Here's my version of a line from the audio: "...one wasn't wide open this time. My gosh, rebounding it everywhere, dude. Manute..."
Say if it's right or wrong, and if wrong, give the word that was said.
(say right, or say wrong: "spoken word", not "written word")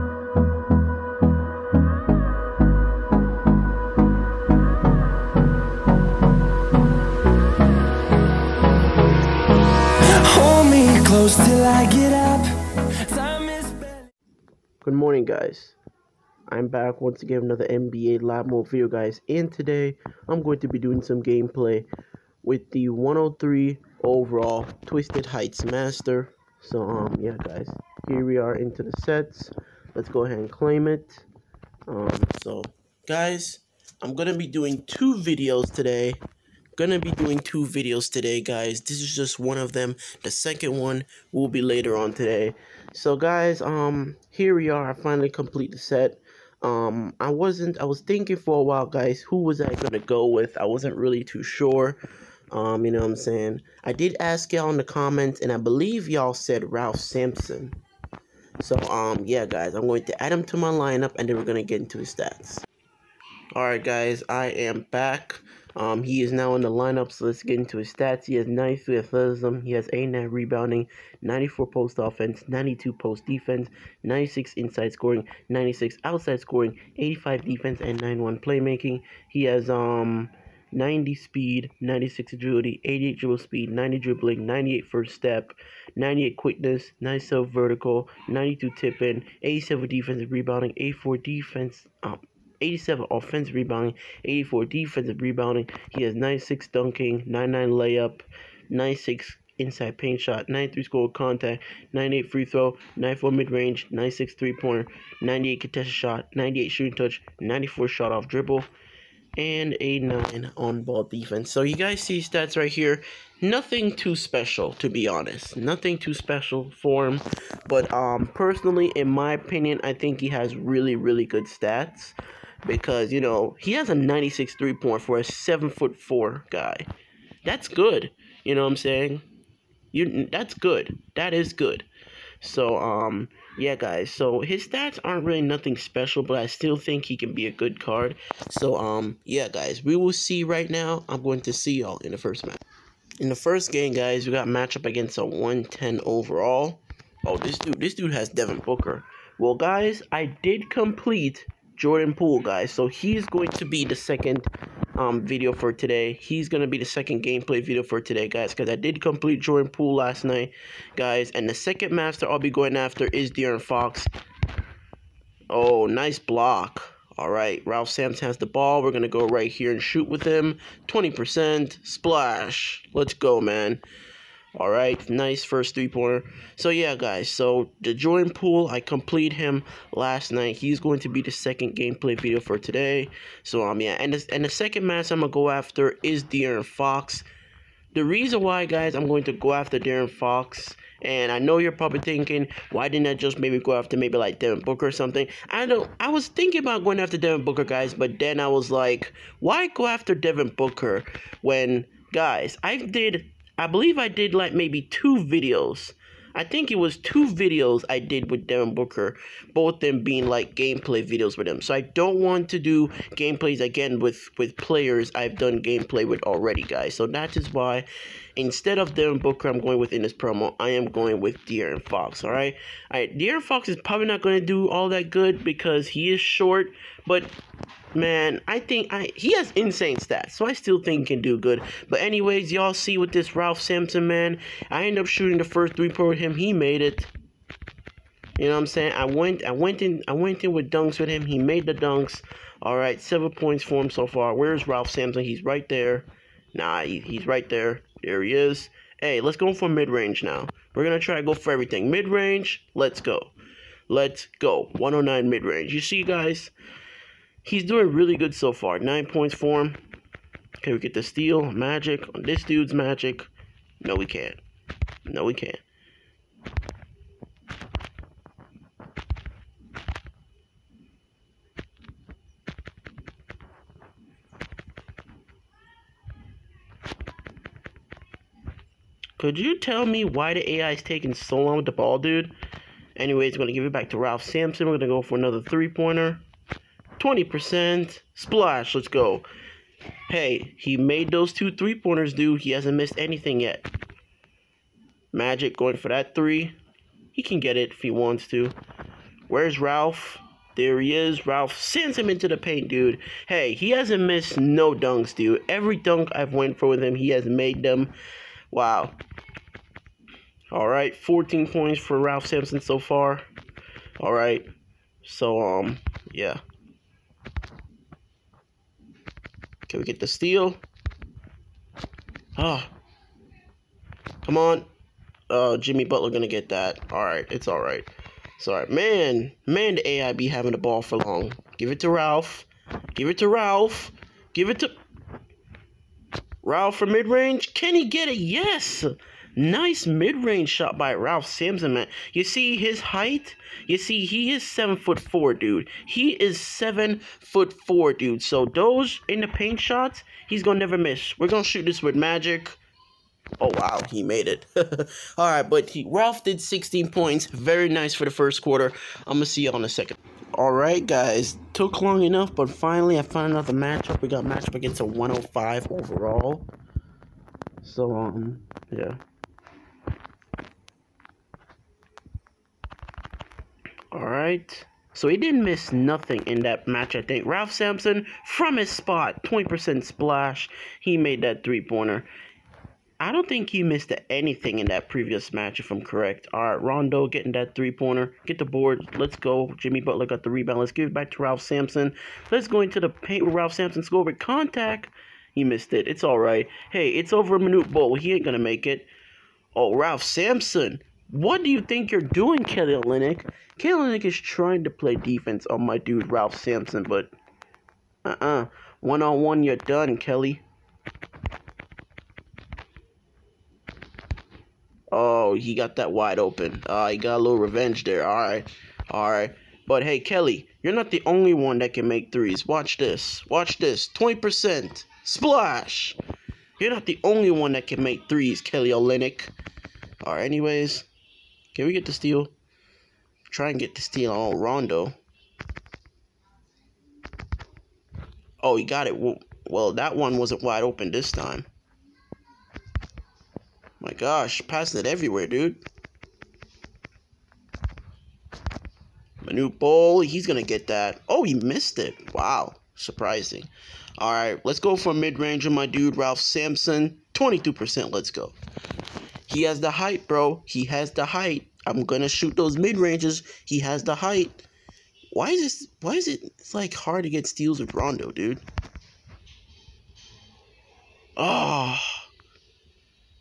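wrong: "passing", not "rebounding".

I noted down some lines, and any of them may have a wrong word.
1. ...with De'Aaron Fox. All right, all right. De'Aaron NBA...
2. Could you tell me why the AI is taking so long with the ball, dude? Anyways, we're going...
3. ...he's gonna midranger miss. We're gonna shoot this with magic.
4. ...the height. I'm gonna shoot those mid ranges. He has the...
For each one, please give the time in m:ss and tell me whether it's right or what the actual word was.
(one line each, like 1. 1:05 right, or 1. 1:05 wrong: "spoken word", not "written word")
1. 3:41 wrong: "Fox", not "NBA"
2. 4:39 right
3. 5:50 wrong: "never", not "midranger"
4. 7:40 right.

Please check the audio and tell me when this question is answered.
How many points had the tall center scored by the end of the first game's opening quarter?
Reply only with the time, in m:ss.
5:56.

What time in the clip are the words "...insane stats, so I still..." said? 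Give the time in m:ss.
3:49.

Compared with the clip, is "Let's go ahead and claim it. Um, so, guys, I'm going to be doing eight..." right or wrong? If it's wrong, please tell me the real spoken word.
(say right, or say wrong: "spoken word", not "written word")
wrong: "two", not "eight".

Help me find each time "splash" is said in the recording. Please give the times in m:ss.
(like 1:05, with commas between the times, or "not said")
2:51, 4:48, 6:19, 7:05.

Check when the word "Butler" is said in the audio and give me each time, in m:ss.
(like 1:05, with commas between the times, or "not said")
5:25, 6:29.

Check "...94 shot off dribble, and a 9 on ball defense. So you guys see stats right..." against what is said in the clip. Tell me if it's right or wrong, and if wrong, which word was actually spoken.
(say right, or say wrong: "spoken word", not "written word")
right.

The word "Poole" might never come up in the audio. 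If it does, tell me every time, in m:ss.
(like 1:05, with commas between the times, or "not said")
2:32, 2:39, 2:58.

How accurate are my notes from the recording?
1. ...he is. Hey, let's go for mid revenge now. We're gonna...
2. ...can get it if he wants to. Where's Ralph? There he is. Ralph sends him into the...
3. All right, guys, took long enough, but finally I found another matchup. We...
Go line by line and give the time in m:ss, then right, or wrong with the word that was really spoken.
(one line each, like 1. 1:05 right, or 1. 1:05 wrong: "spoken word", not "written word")
1. 4:08 wrong: "range", not "revenge"
2. 4:57 right
3. 6:00 right.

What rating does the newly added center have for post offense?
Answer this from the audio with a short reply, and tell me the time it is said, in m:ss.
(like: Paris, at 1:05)
94, at 1:11.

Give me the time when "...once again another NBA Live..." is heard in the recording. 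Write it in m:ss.
0:17.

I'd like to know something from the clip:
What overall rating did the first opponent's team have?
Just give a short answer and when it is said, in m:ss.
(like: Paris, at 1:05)
110, at 2:25.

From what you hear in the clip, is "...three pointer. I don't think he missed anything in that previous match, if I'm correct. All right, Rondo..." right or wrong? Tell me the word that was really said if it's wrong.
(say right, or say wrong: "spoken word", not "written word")
right.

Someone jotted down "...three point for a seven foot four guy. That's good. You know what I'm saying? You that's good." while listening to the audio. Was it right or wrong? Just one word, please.
right.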